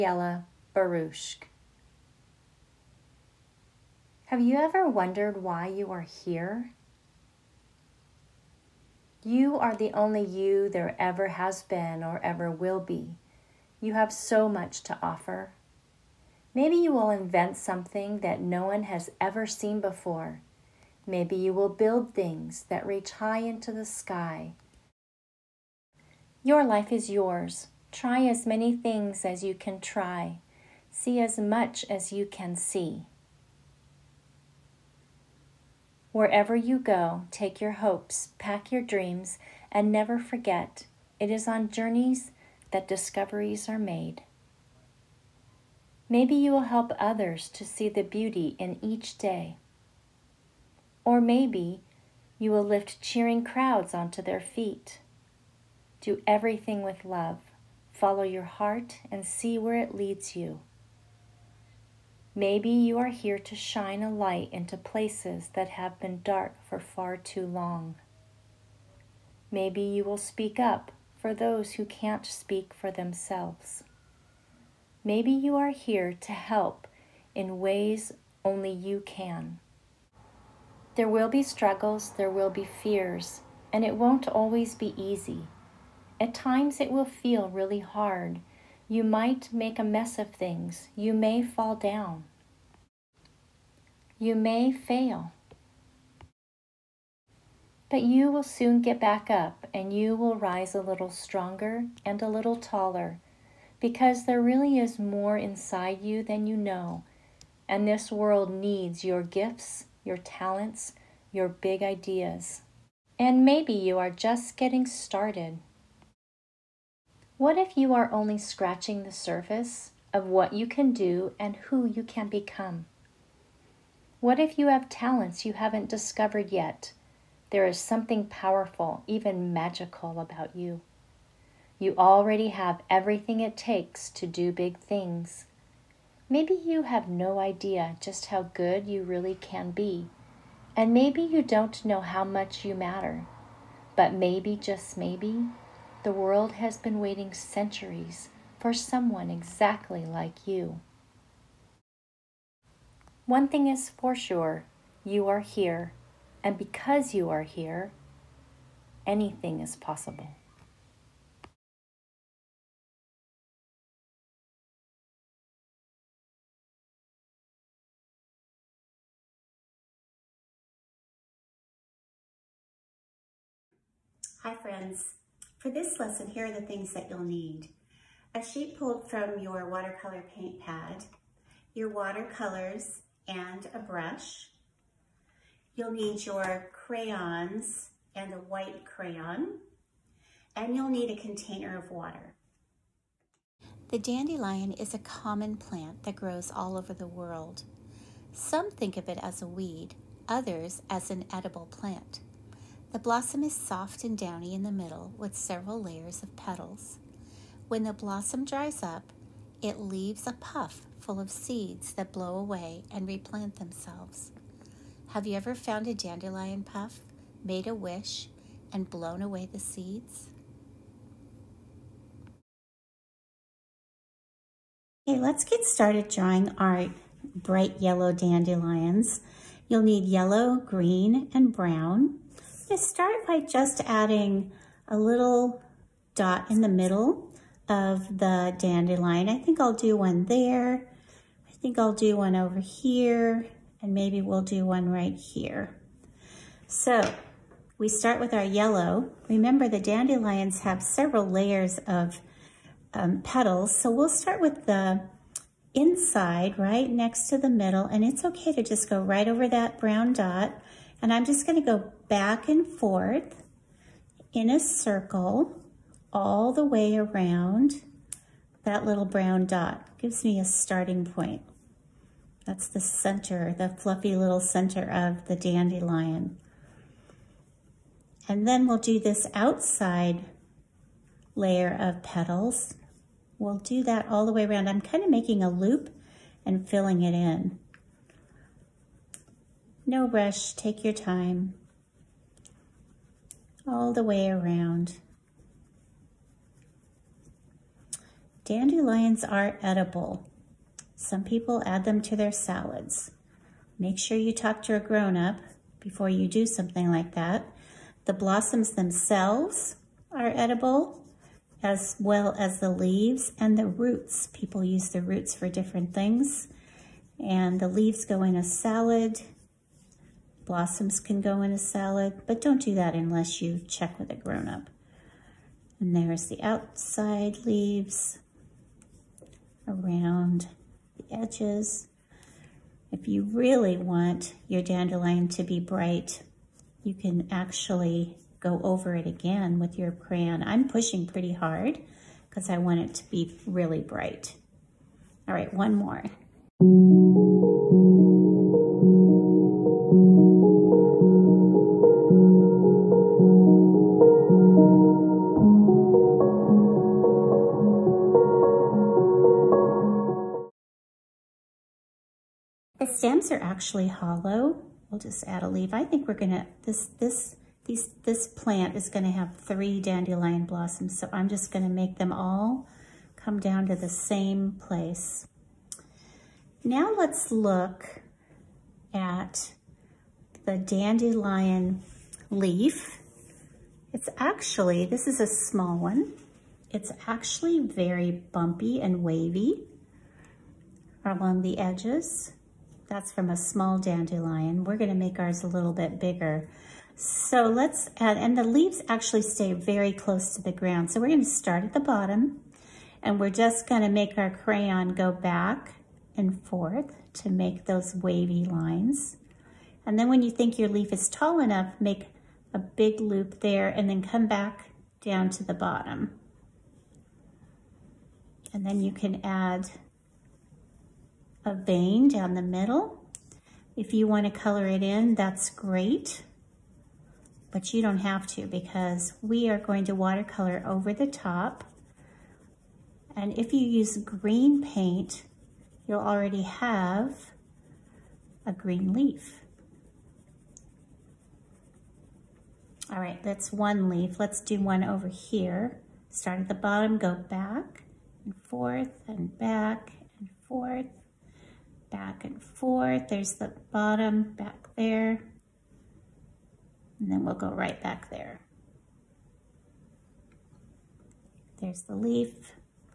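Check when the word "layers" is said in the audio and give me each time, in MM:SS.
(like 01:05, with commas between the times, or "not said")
03:25, 04:11, 04:41.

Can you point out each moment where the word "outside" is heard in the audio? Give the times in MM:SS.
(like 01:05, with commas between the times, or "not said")
04:39, 05:26.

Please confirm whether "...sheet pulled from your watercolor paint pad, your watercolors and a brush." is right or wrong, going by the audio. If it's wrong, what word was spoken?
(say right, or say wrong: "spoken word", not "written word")
right.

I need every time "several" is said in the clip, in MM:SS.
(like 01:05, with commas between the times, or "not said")
03:25, 04:10.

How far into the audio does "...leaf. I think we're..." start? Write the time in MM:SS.
06:05.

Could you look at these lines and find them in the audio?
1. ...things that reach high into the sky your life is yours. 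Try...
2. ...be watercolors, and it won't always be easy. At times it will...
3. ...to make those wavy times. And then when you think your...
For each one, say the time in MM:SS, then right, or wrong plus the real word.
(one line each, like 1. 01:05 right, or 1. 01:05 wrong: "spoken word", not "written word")
1. 00:22 right
2. 01:22 wrong: "fears", not "watercolors"
3. 06:47 wrong: "lines", not "times".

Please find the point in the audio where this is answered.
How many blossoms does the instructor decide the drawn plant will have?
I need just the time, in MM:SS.
06:09.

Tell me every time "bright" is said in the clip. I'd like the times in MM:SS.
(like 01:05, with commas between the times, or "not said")
03:47, 05:35, 05:43.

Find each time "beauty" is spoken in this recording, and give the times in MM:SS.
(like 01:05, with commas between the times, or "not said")
00:48.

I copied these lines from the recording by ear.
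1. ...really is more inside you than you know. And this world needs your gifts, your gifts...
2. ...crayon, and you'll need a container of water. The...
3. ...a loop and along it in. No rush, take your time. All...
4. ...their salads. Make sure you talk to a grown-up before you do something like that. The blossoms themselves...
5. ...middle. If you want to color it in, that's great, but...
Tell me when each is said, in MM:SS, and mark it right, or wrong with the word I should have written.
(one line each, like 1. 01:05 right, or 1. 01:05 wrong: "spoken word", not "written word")
1. 01:44 wrong: "talents", not "gifts"
2. 03:08 right
3. 04:45 wrong: "filling", not "along"
4. 05:02 right
5. 07:02 right.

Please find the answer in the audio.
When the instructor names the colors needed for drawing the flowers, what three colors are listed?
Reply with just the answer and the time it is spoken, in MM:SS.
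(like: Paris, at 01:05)
yellow, green, and brown, at 03:50.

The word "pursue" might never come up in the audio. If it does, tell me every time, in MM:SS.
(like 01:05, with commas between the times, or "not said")
not said.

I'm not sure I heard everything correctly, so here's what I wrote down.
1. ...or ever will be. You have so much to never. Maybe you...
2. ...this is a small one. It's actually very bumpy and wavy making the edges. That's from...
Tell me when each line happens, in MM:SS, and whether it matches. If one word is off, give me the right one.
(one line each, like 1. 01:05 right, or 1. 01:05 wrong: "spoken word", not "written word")
1. 00:12 wrong: "offer", not "never"
2. 06:24 wrong: "along", not "making".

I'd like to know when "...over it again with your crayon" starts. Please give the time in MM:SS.
05:38.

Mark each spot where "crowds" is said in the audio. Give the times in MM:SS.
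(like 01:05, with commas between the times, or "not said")
00:53.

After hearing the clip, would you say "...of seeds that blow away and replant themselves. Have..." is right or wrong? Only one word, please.
right.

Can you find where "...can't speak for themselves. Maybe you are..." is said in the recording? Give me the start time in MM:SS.
01:11.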